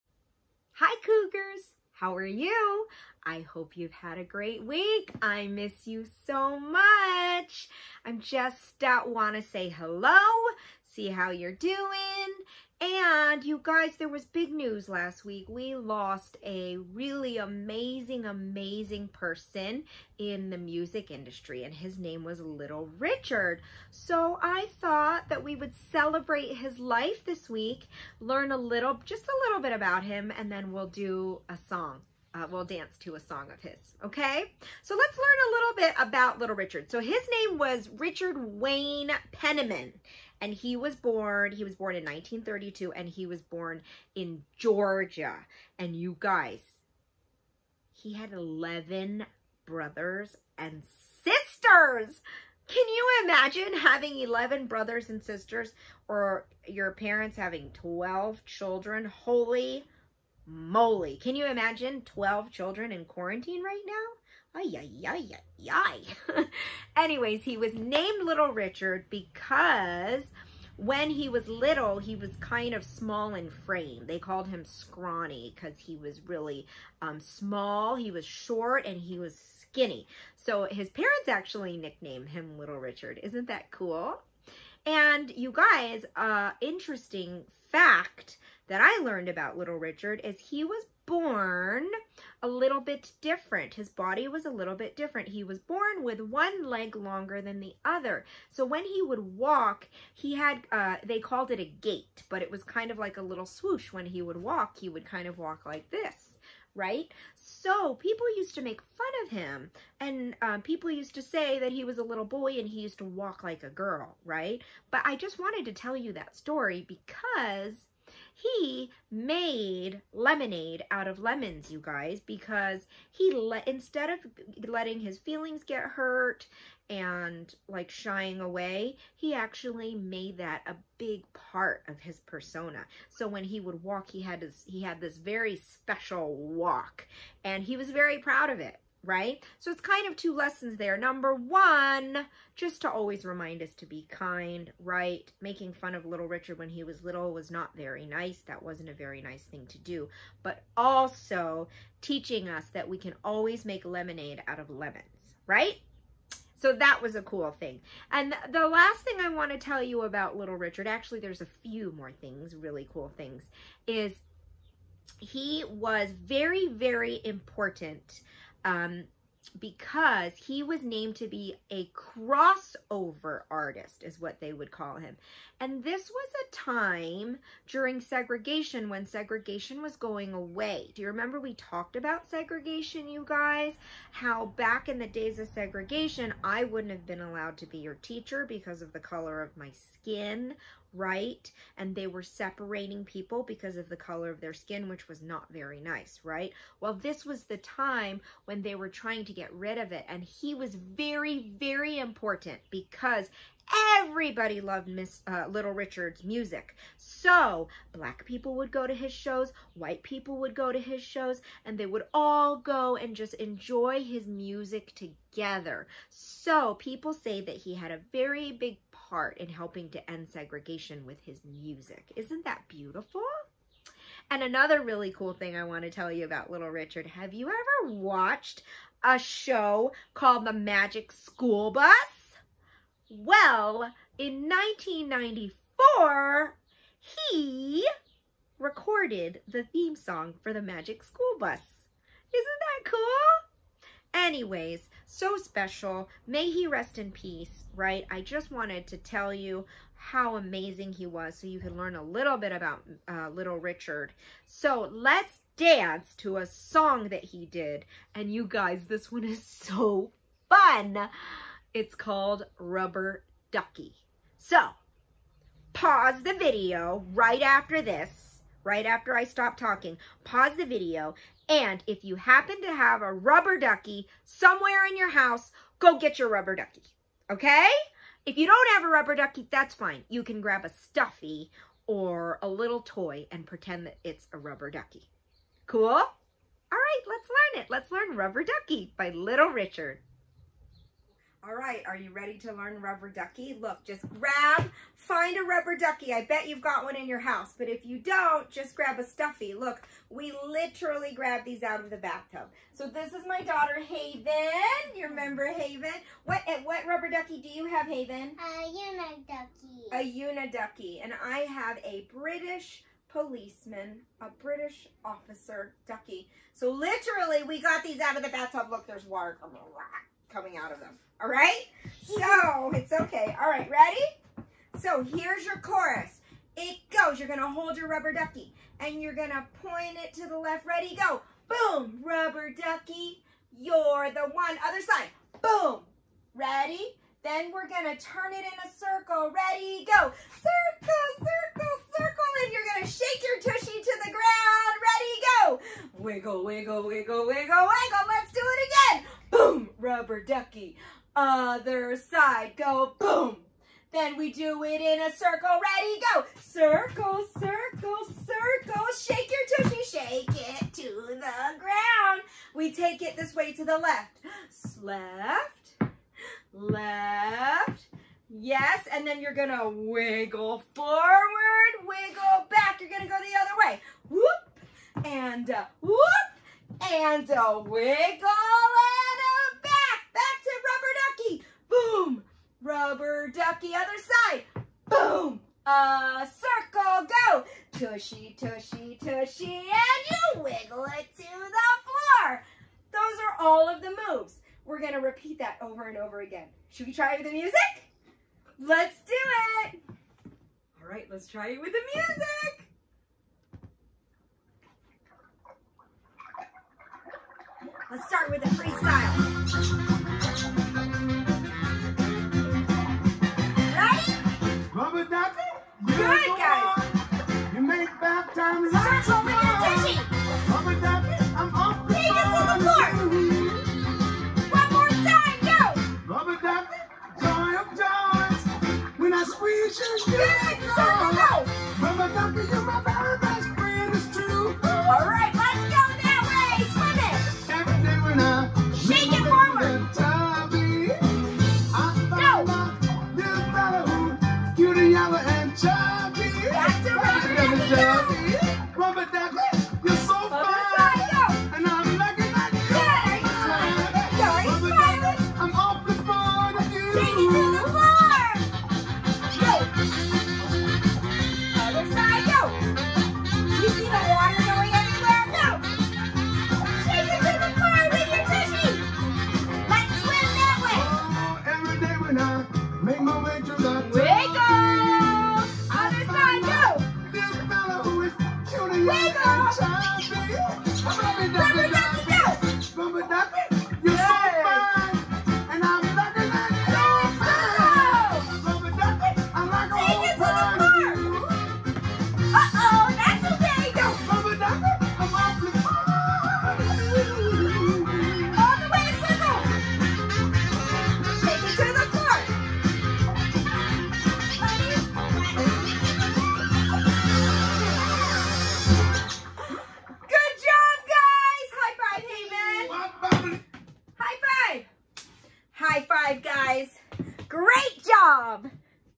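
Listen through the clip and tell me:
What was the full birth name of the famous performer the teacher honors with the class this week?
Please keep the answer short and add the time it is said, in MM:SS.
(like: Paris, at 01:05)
Richard Wayne Penniman, at 00:37.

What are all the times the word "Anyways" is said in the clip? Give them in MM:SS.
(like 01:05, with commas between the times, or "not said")
01:07, 04:04.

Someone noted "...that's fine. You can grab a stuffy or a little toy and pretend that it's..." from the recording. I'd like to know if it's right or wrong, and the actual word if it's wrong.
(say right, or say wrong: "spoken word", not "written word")
right.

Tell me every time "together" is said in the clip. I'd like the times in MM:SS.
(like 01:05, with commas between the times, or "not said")
03:34.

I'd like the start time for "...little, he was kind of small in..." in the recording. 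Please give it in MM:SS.
01:11.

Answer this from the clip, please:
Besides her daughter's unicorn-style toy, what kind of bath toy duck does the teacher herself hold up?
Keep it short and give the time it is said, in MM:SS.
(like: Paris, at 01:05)
British policeman, at 05:12.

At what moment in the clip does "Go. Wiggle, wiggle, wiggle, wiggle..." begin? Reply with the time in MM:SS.
05:45.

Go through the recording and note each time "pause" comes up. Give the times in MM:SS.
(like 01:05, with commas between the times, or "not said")
04:25, 04:30.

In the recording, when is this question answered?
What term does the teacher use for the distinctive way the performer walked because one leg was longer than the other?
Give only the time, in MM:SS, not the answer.
01:41.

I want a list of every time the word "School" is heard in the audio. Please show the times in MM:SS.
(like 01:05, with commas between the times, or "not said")
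03:51, 04:01.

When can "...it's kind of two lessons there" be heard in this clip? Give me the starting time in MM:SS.
02:19.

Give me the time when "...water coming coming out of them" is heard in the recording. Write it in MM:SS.
05:19.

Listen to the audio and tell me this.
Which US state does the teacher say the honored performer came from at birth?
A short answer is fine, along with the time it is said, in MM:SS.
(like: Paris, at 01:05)
Georgia, at 00:44.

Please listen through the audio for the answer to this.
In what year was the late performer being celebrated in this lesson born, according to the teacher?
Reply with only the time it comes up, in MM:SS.
00:42.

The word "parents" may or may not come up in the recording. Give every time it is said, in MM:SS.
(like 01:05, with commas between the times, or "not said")
00:56, 01:20.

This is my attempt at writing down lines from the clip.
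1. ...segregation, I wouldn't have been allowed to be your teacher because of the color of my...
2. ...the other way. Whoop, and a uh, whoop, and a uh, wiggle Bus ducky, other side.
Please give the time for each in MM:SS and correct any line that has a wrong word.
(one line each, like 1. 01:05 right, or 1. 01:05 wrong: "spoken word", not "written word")
1. 03:05 right
2. 06:13 wrong: "Rubber", not "Bus".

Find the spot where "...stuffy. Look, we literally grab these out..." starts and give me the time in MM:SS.
04:59.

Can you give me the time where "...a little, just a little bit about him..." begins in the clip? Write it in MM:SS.
00:28.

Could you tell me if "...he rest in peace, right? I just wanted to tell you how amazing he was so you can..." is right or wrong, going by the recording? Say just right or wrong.
right.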